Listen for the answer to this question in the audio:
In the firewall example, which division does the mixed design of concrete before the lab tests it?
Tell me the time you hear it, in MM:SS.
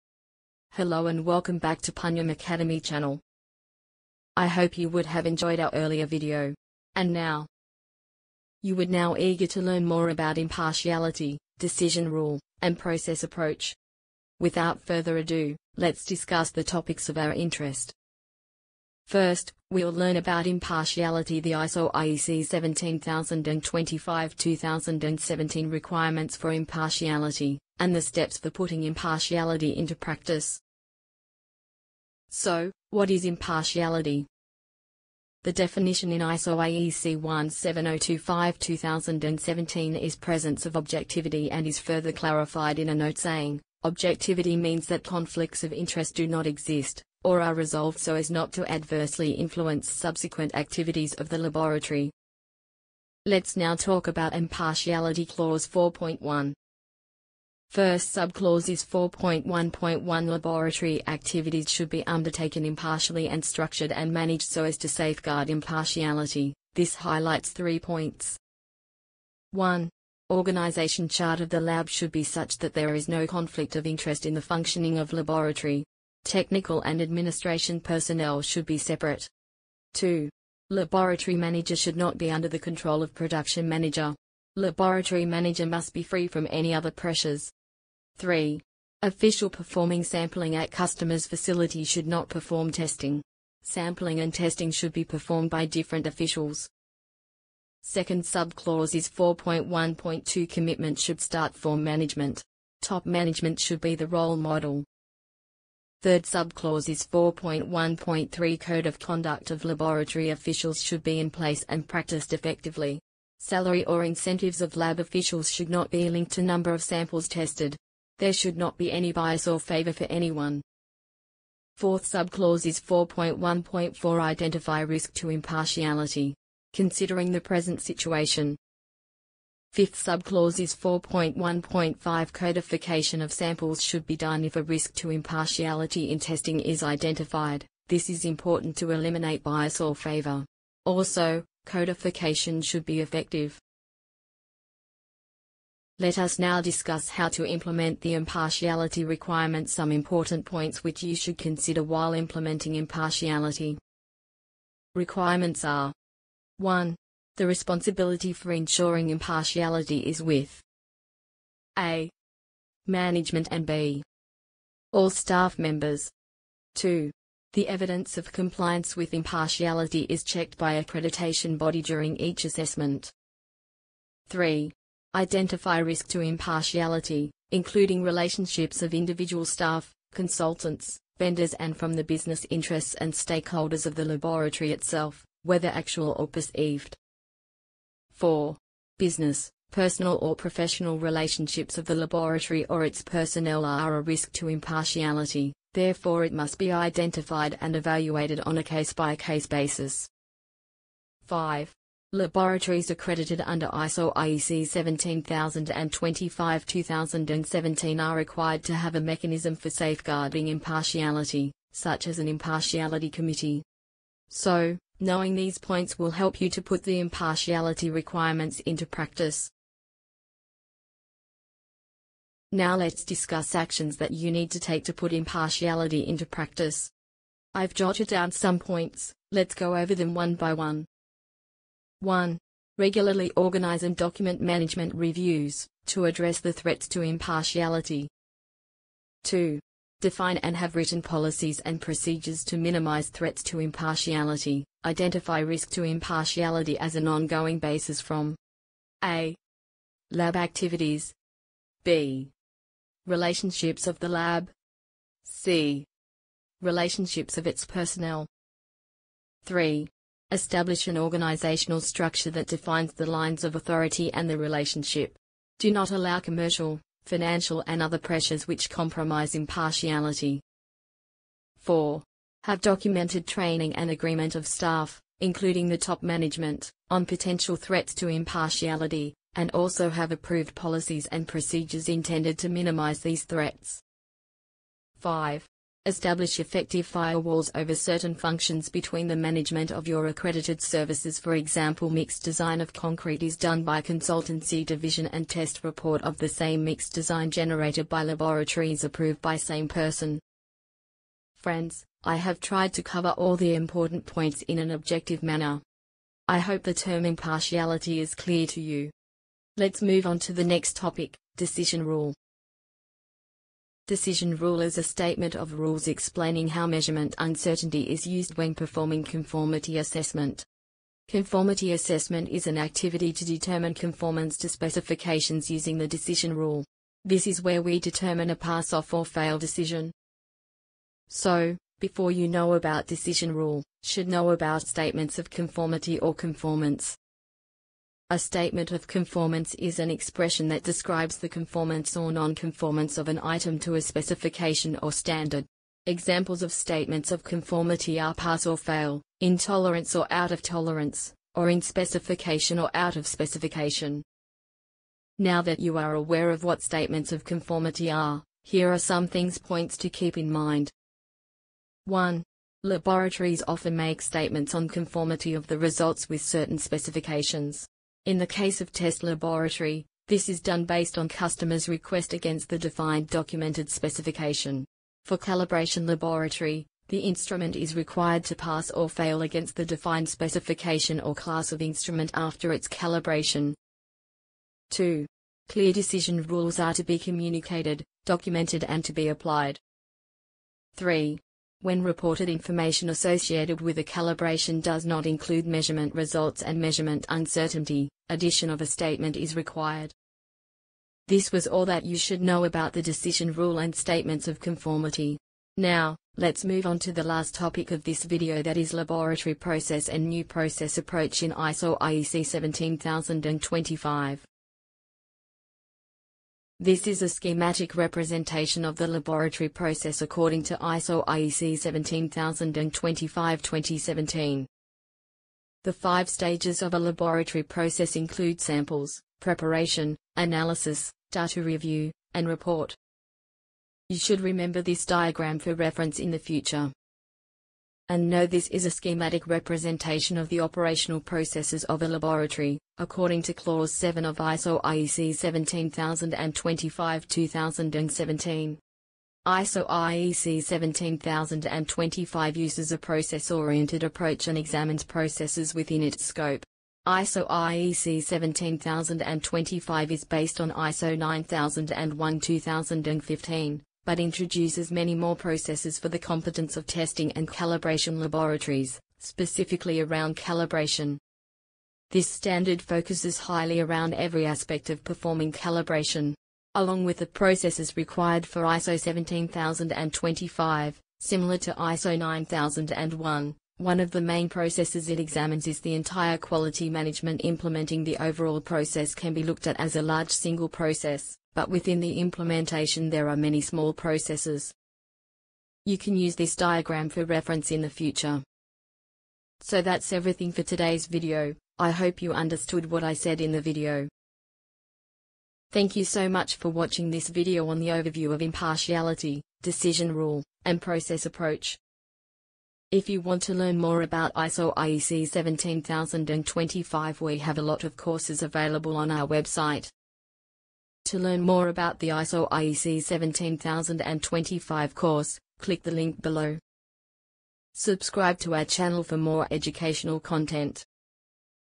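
04:53.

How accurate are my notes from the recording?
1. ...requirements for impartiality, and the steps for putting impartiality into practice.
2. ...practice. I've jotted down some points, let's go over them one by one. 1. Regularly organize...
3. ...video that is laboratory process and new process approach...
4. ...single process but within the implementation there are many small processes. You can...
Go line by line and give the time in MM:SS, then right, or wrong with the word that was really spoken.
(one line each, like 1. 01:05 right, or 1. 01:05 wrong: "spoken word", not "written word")
1. 00:25 right
2. 03:46 right
3. 06:48 right
4. 08:10 right.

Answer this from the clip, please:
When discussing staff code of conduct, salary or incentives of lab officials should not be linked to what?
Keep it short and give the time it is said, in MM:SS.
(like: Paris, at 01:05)
Number of samples tested, at 01:56.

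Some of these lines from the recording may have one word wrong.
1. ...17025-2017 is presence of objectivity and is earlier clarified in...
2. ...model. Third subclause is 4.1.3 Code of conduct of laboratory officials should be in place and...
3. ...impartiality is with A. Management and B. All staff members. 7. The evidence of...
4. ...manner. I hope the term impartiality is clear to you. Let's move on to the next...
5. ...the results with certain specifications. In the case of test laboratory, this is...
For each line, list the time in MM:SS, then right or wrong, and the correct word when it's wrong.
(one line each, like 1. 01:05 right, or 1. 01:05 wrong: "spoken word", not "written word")
1. 00:37 wrong: "further", not "earlier"
2. 01:44 right
3. 02:39 wrong: "2", not "7"
4. 05:05 right
5. 06:05 right.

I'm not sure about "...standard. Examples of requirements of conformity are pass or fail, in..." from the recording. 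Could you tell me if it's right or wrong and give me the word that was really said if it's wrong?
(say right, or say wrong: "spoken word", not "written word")
wrong: "statements", not "requirements".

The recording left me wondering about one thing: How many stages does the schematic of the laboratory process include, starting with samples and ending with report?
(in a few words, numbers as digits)
5.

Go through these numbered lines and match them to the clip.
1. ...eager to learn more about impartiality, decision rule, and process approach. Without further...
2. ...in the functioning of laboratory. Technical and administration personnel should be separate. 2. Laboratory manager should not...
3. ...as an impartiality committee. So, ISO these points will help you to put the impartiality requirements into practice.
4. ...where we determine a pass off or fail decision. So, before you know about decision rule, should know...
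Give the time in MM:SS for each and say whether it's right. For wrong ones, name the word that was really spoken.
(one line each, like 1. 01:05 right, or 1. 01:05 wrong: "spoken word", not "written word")
1. 00:09 right
2. 01:14 right
3. 03:32 wrong: "Knowing", not "ISO"
4. 05:27 right.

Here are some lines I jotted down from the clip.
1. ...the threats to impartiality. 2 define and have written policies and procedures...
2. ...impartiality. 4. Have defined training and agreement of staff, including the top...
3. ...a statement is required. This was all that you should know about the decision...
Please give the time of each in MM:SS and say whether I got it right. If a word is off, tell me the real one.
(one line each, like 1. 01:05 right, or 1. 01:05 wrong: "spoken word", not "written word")
1. 03:56 right
2. 04:29 wrong: "documented", not "defined"
3. 06:38 right.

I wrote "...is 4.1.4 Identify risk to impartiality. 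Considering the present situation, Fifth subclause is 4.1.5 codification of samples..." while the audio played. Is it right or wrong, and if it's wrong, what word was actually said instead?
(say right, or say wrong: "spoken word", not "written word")
right.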